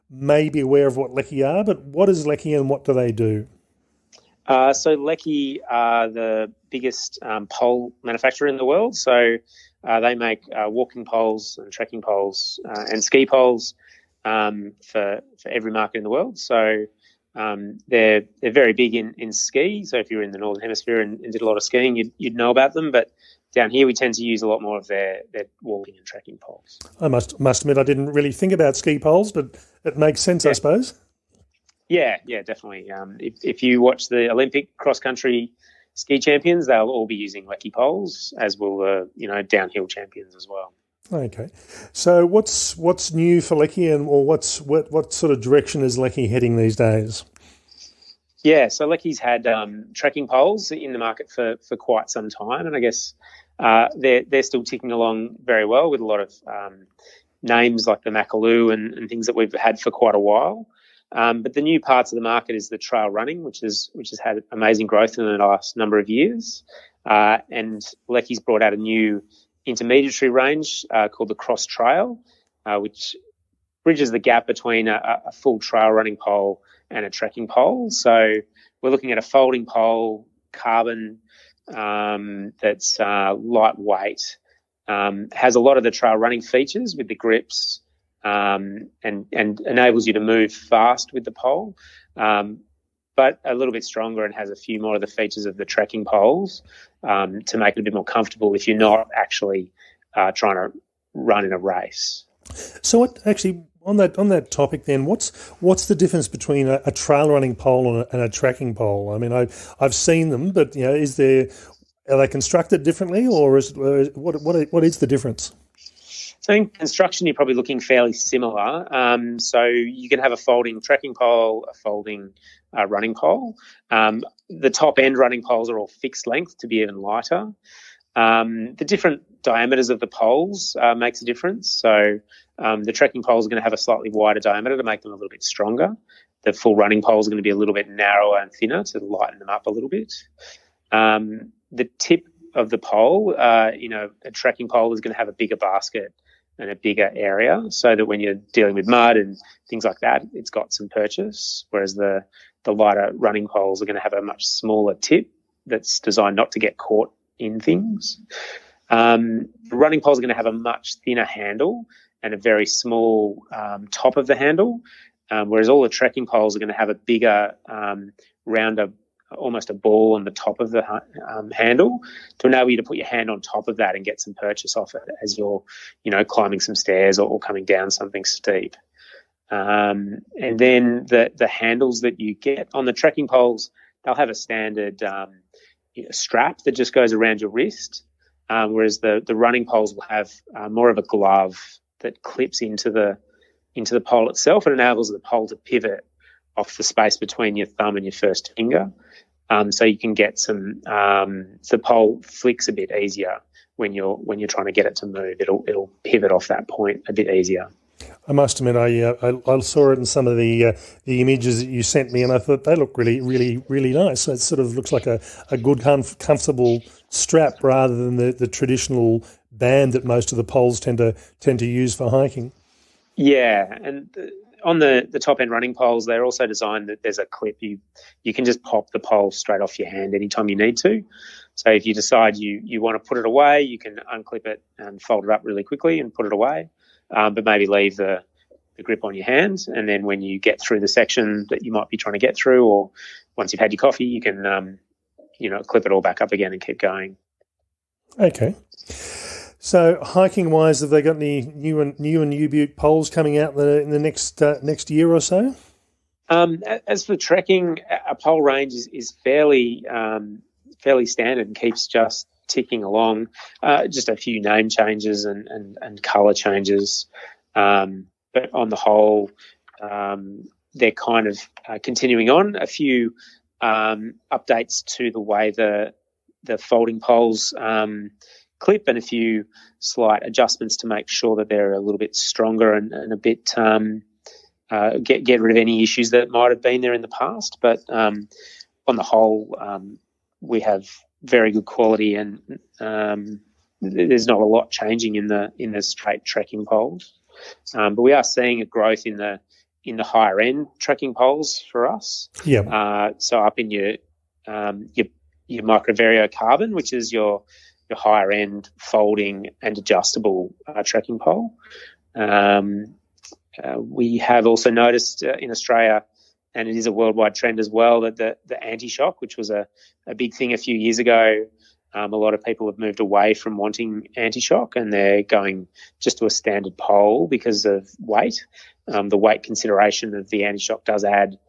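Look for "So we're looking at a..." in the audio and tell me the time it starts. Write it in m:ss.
1:17.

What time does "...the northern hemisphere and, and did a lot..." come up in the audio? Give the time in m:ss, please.
0:20.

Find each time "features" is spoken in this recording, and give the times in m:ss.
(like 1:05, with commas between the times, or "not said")
1:26, 1:35.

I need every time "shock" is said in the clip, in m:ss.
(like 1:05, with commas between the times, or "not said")
5:18, 5:24, 5:30.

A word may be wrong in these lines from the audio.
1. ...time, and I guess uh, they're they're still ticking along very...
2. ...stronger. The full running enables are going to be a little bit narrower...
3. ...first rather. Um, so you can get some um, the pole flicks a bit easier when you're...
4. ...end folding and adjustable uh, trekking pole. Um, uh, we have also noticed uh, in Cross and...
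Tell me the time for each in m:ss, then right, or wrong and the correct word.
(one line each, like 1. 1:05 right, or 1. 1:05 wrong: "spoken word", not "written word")
1. 0:52 right
2. 2:15 wrong: "poles", not "enables"
3. 3:18 wrong: "finger", not "rather"
4. 5:08 wrong: "Australia", not "Cross".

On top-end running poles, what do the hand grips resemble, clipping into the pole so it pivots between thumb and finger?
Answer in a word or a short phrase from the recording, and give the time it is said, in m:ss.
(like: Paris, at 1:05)
A glove, at 3:10.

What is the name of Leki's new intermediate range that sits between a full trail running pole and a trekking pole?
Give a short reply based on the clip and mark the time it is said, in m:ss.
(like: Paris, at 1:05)
Cross Trail, at 1:11.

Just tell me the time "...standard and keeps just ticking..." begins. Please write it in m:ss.
4:21.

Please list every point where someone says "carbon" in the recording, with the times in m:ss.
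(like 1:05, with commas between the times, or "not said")
1:20, 5:06.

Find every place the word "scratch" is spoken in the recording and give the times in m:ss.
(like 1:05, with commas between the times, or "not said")
not said.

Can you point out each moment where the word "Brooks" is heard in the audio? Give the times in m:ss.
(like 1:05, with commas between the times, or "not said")
not said.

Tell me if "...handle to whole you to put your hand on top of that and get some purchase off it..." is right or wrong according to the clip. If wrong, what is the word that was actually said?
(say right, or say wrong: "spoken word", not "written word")
wrong: "enable", not "whole".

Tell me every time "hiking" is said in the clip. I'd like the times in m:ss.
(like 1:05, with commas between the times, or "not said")
3:42, 4:10.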